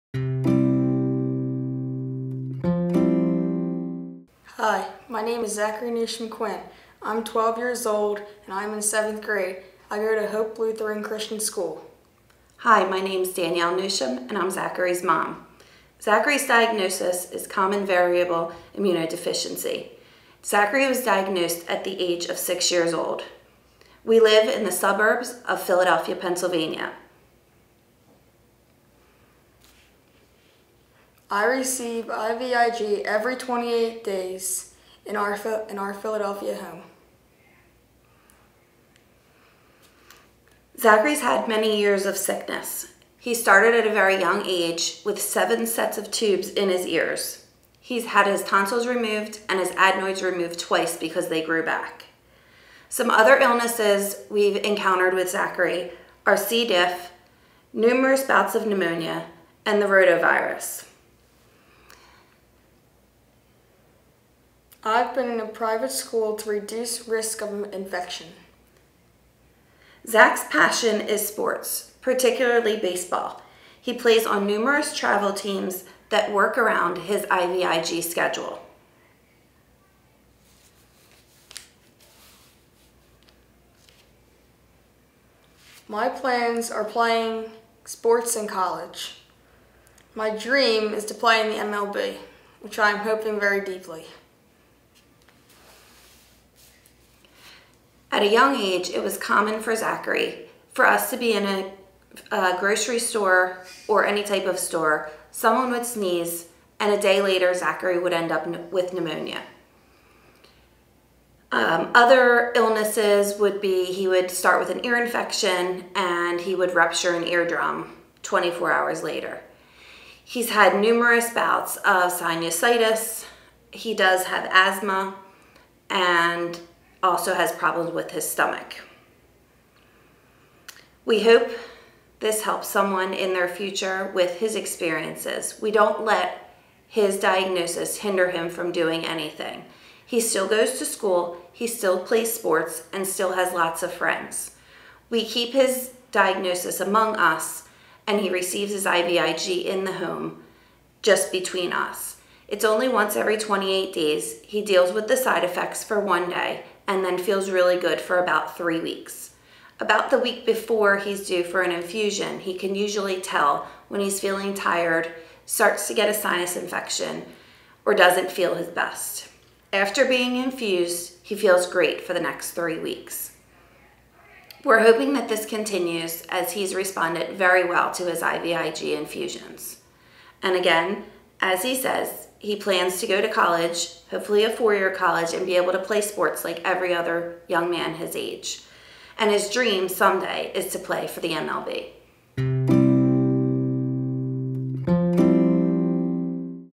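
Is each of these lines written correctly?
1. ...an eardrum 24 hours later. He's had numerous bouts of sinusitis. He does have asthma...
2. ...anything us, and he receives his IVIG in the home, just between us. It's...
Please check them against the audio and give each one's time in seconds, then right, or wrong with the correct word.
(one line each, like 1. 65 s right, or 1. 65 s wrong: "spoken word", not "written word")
1. 117 s right
2. 146 s wrong: "among", not "anything".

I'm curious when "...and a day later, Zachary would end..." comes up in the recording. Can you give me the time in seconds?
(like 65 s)
106 s.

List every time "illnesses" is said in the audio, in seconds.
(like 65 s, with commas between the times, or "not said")
53 s, 112 s.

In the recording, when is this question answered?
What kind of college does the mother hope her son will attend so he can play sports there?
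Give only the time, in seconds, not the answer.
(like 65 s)
184 s.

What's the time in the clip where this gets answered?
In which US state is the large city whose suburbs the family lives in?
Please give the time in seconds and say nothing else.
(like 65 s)
26 s.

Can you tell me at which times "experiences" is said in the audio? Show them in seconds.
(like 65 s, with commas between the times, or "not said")
134 s.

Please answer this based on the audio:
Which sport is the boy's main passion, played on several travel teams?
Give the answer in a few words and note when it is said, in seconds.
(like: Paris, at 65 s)
Baseball, at 72 s.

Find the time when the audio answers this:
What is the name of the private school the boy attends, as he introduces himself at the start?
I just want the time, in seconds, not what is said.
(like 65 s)
10 s.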